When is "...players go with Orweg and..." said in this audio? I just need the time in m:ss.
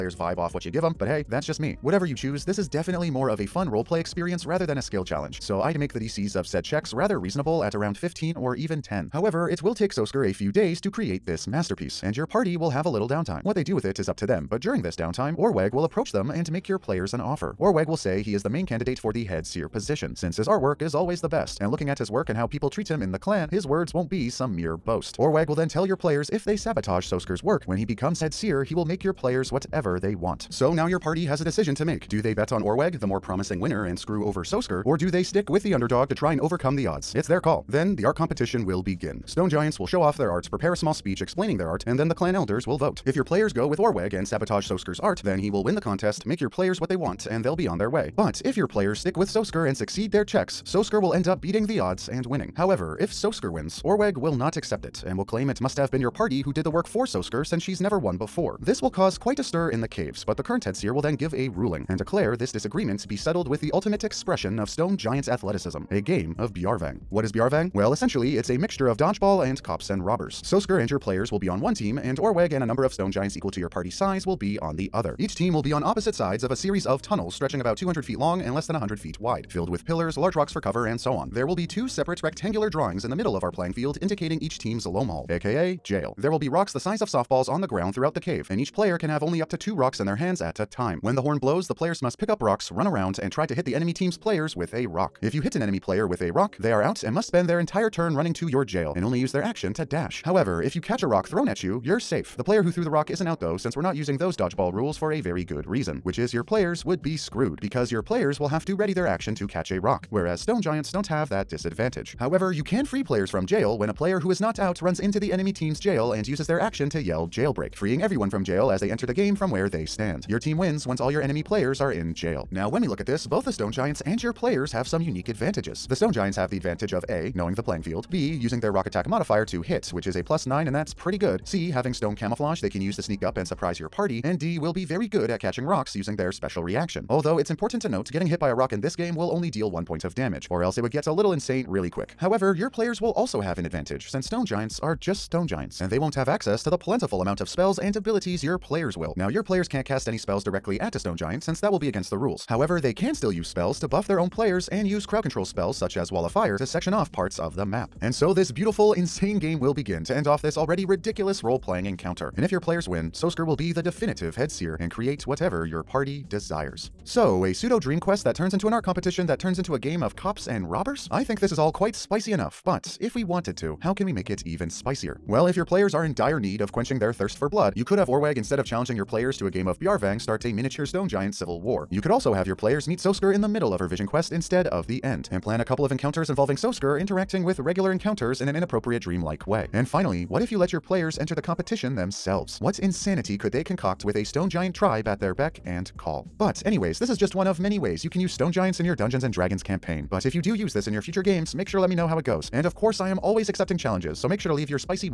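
0:43.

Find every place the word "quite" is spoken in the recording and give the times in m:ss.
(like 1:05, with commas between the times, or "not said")
0:59, 2:51.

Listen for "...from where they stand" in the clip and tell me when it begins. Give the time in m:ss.
1:59.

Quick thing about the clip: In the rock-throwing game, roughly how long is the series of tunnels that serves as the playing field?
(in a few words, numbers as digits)
200 feet.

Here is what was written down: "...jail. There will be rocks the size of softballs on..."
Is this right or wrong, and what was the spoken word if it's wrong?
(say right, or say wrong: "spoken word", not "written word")
right.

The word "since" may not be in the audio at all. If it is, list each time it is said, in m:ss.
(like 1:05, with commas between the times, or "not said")
0:20, 0:57, 1:43, 2:24, 2:31.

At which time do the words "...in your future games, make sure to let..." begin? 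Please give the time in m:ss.
3:20.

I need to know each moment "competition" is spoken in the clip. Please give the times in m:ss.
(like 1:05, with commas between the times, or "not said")
0:38, 2:48, 3:11.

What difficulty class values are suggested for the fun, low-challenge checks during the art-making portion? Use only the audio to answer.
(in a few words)
15 or 10.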